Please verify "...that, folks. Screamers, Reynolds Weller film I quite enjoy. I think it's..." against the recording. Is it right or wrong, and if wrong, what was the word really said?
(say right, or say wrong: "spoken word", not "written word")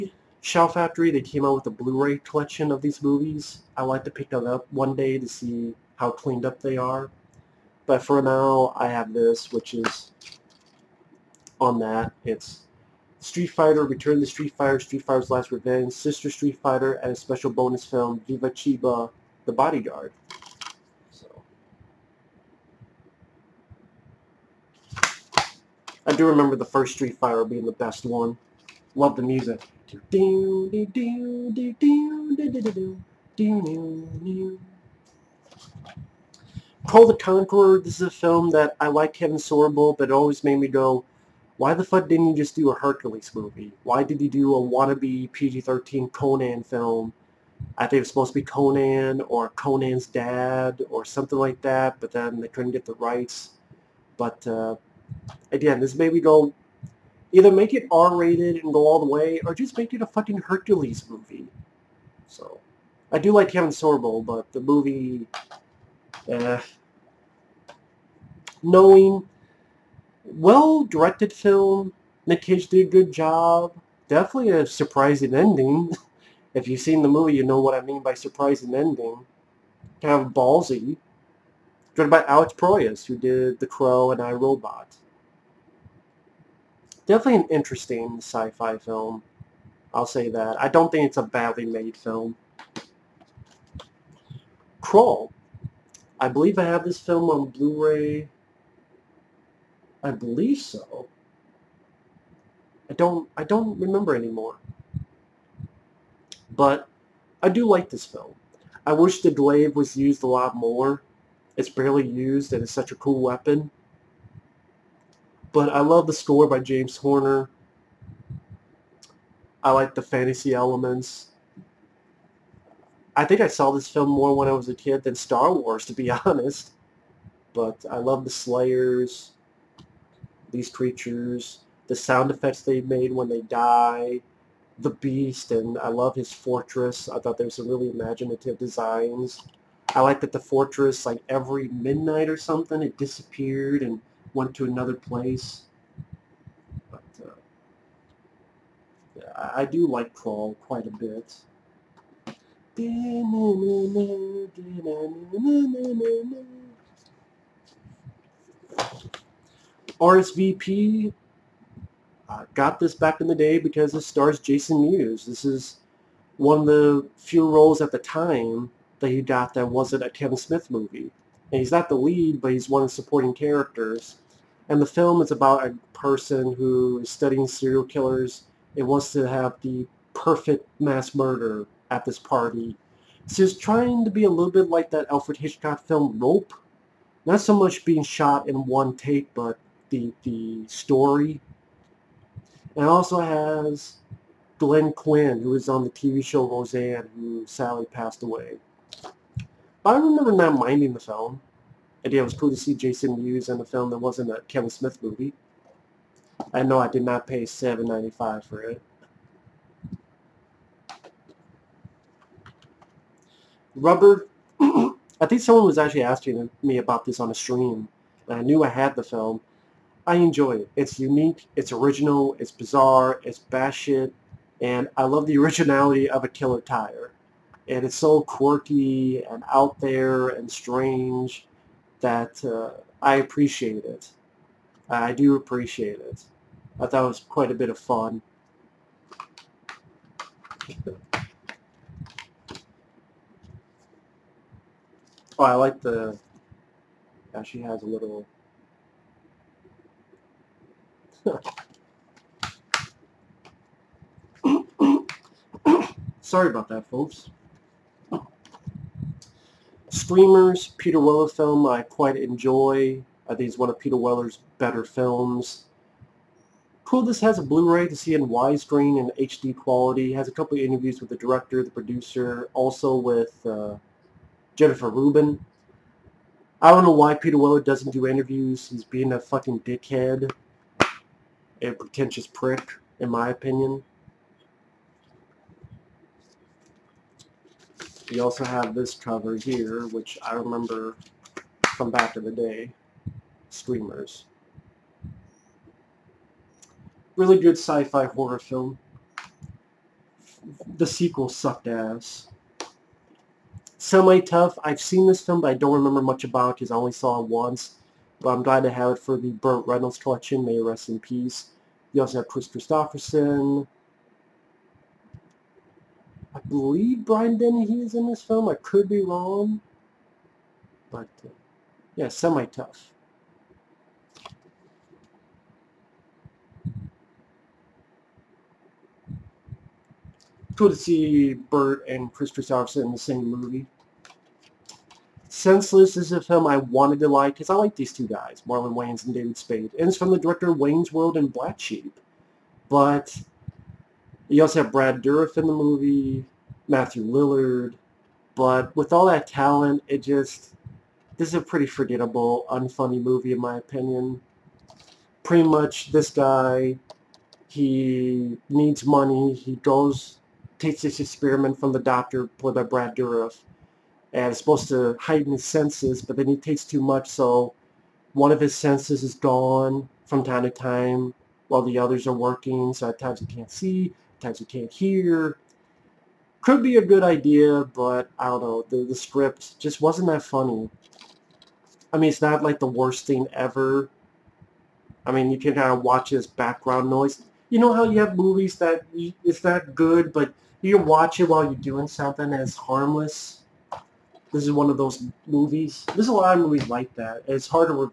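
wrong: "Peter", not "Reynolds".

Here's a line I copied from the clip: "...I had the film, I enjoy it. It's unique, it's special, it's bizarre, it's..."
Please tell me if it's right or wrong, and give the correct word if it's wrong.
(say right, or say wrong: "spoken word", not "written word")
wrong: "original", not "special".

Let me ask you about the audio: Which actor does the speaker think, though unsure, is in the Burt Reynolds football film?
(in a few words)
Brian Dennehy.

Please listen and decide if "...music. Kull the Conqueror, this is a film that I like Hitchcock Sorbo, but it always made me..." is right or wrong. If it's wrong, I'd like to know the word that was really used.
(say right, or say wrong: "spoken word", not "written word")
wrong: "Kevin", not "Hitchcock".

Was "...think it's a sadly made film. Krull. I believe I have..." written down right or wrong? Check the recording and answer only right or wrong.
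wrong.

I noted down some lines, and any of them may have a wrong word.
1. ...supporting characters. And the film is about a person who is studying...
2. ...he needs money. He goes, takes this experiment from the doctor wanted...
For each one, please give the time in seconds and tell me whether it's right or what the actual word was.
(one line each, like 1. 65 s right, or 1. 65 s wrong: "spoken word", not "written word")
1. 172 s right
2. 357 s wrong: "played", not "wanted".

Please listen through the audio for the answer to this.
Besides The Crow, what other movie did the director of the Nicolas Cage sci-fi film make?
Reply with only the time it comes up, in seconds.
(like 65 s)
84 s.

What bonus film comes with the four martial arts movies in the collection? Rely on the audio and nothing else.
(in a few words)
Viva Chiba, The Bodyguard.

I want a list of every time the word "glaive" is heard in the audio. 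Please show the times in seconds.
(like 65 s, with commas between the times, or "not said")
109 s.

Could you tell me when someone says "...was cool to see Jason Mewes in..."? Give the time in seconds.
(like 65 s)
202 s.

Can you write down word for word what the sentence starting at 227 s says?
And it's so quirky and out there and strange that uh, I appreciate it.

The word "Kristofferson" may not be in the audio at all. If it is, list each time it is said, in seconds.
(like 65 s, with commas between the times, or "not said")
312 s, 332 s.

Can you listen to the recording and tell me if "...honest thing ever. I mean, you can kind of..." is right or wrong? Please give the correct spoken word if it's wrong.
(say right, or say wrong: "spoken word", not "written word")
wrong: "worst", not "honest".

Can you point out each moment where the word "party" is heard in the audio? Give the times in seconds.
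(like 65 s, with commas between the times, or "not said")
182 s.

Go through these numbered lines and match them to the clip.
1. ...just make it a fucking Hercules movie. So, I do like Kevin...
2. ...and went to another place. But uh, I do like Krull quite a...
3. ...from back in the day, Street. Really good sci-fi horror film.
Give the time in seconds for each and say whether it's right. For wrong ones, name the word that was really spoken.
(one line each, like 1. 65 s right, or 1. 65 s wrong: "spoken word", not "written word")
1. 59 s right
2. 143 s right
3. 291 s wrong: "Screamers", not "Street".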